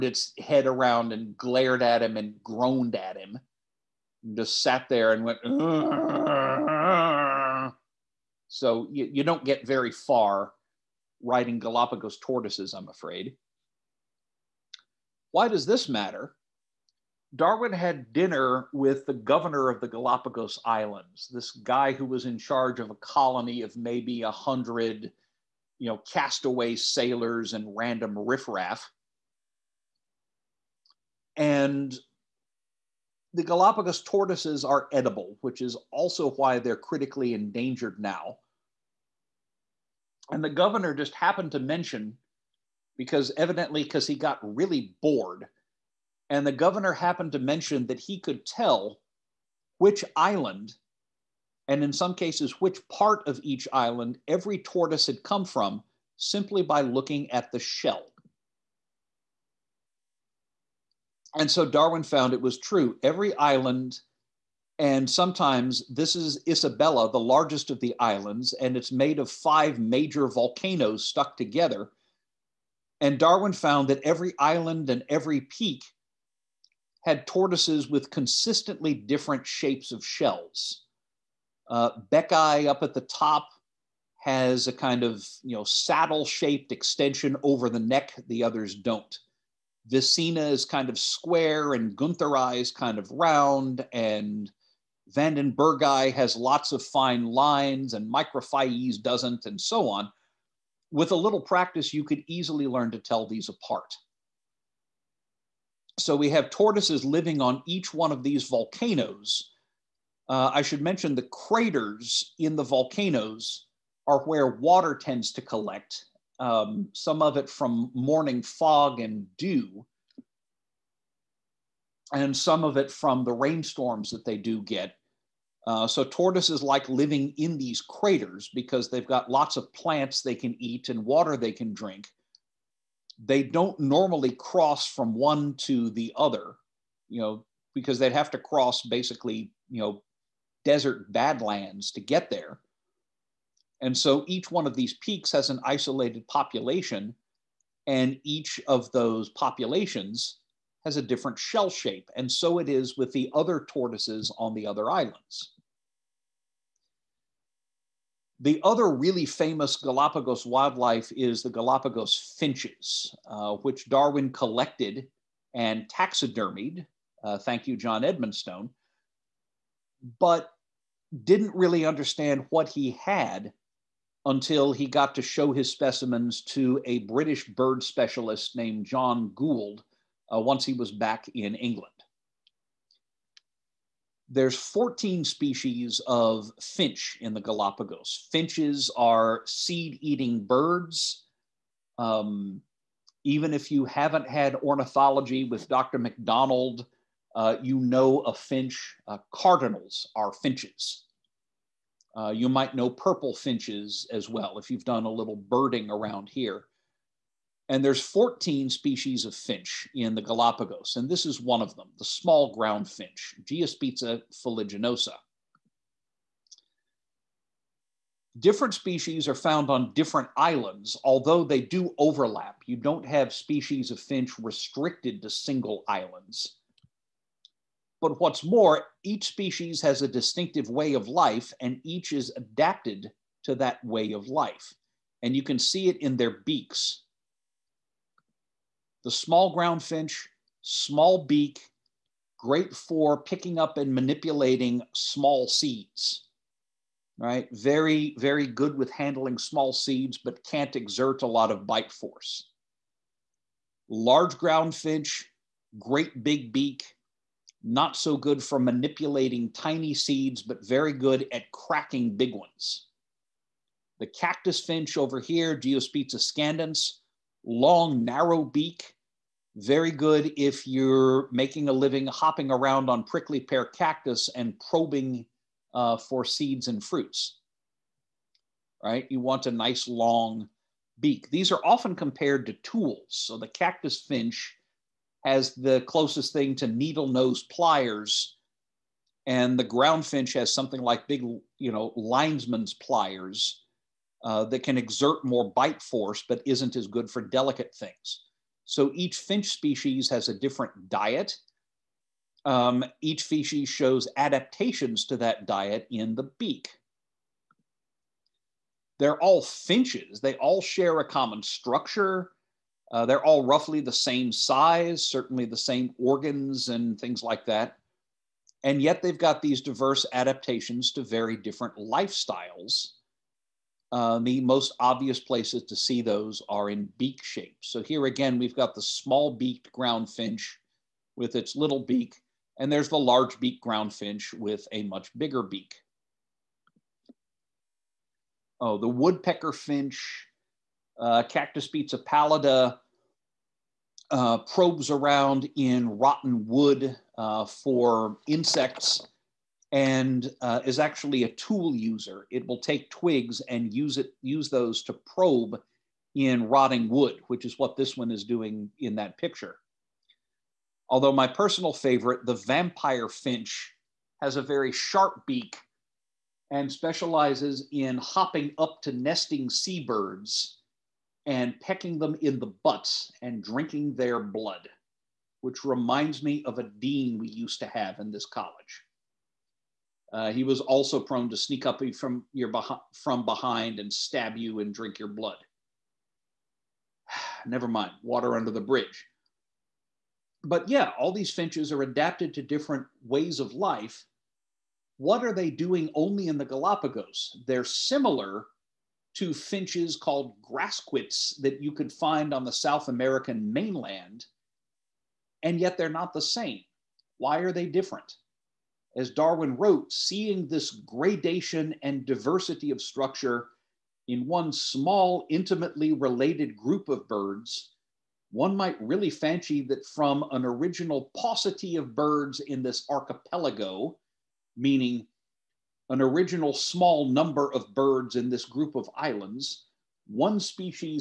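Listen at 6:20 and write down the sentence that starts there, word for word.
Uh, he was also prone to sneak up from your behind, from behind and stab you and drink your blood.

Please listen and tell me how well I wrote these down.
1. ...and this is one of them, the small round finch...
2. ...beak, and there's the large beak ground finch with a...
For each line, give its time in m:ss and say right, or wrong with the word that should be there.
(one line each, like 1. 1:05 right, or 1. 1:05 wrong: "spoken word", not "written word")
1. 3:30 wrong: "ground", not "round"
2. 5:31 right.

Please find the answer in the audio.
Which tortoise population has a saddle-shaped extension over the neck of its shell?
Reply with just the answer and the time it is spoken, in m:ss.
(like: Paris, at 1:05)
Beckei, at 1:22.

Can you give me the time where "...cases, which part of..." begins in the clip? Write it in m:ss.
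0:52.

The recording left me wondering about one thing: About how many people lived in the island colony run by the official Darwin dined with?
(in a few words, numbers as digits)
100.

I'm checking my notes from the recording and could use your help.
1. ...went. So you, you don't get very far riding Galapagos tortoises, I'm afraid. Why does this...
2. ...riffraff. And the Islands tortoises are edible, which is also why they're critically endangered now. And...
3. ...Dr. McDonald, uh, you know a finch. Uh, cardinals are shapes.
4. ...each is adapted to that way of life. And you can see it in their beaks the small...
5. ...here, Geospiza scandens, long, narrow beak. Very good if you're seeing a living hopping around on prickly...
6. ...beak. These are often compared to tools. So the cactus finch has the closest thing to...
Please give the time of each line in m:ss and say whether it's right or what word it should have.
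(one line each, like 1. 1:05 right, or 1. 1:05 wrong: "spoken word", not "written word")
1. 0:05 right
2. 0:28 wrong: "Galapagos", not "Islands"
3. 3:15 wrong: "finches", not "shapes"
4. 3:51 right
5. 4:25 wrong: "making", not "seeing"
6. 4:40 right.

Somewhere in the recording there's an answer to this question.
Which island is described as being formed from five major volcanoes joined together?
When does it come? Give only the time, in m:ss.
1:06.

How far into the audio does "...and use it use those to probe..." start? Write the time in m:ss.
5:53.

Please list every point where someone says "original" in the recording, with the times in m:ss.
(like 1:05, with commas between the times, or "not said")
7:00, 7:06.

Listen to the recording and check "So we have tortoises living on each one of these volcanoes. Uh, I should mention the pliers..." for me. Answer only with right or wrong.
wrong.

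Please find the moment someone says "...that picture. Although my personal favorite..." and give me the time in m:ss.
5:58.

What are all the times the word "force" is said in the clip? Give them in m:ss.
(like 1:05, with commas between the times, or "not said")
4:11, 4:55.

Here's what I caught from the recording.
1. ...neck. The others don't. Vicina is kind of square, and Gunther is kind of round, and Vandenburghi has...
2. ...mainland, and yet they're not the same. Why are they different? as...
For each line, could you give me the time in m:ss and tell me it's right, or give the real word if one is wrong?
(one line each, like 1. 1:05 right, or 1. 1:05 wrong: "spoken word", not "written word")
1. 1:27 right
2. 6:43 right.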